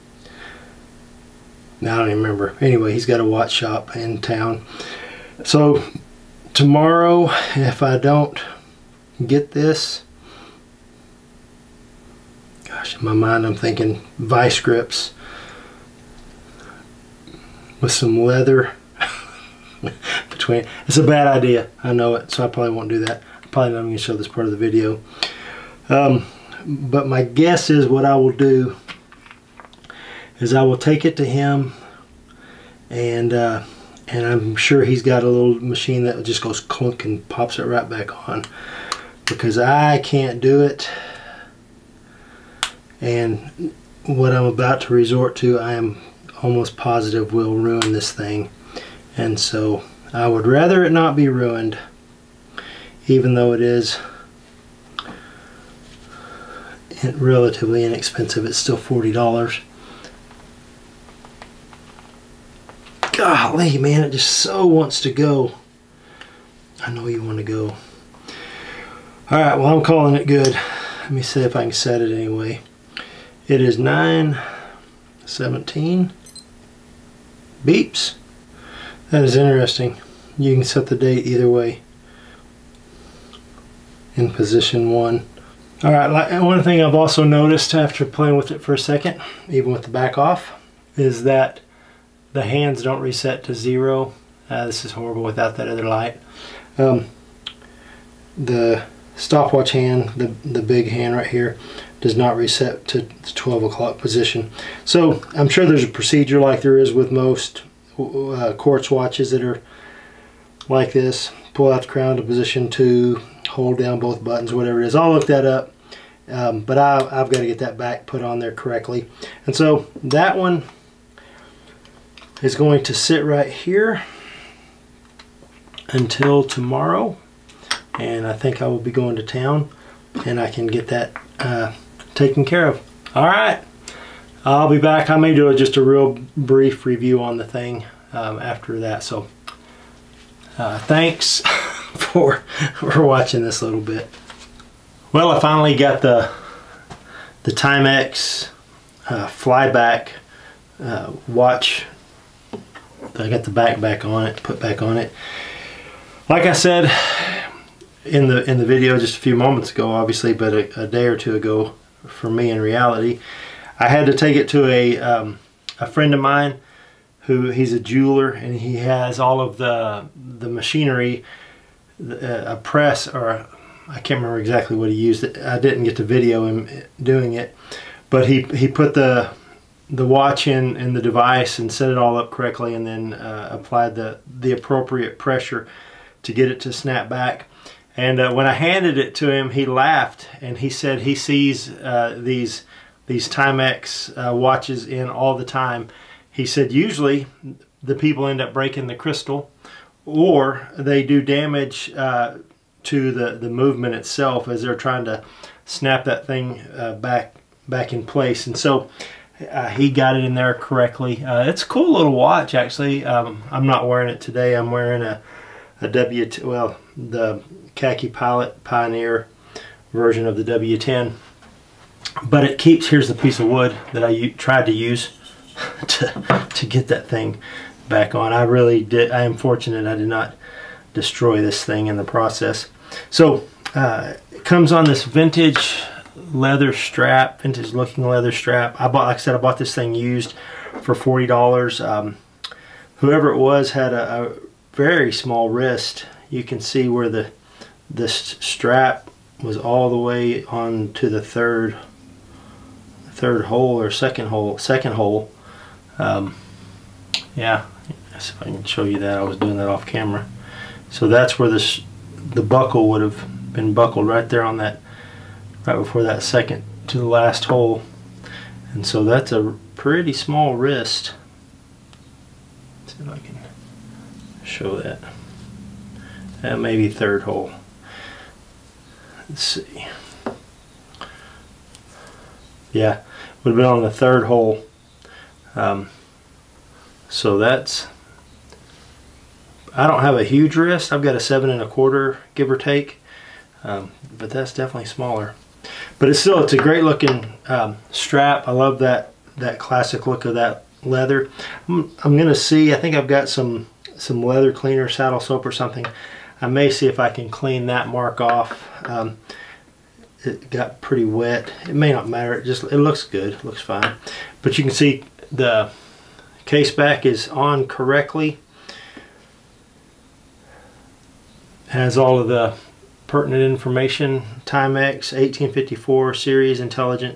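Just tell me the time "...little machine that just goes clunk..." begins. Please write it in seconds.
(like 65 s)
35 s.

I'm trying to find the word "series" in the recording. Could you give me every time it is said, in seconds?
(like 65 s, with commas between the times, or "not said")
326 s.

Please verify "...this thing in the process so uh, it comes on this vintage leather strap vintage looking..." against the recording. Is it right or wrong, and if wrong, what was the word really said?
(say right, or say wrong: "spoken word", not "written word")
right.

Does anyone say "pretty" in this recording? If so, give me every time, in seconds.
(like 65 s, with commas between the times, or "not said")
269 s, 310 s.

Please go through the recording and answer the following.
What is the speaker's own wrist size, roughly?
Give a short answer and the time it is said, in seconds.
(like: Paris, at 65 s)
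7 and a quarter, at 291 s.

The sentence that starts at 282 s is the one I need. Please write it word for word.
Yeah, would have been on the third hole.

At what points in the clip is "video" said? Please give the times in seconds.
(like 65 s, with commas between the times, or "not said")
24 s, 158 s, 176 s.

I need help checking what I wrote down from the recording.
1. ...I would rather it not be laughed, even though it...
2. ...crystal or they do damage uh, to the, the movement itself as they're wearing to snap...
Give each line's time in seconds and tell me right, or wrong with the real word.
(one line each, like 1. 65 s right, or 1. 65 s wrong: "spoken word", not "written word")
1. 50 s wrong: "ruined", not "laughed"
2. 198 s wrong: "trying", not "wearing".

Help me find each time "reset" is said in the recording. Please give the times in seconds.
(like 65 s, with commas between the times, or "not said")
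93 s, 102 s.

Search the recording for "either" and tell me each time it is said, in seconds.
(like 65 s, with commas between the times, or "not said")
81 s.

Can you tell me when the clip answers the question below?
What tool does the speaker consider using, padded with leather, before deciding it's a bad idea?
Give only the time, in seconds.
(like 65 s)
14 s.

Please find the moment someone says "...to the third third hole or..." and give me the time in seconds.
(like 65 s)
250 s.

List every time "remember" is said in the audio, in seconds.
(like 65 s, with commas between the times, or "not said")
2 s, 174 s.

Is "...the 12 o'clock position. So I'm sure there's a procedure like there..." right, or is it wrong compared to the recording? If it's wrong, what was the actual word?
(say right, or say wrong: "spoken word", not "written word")
right.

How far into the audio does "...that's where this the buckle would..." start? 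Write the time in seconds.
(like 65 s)
261 s.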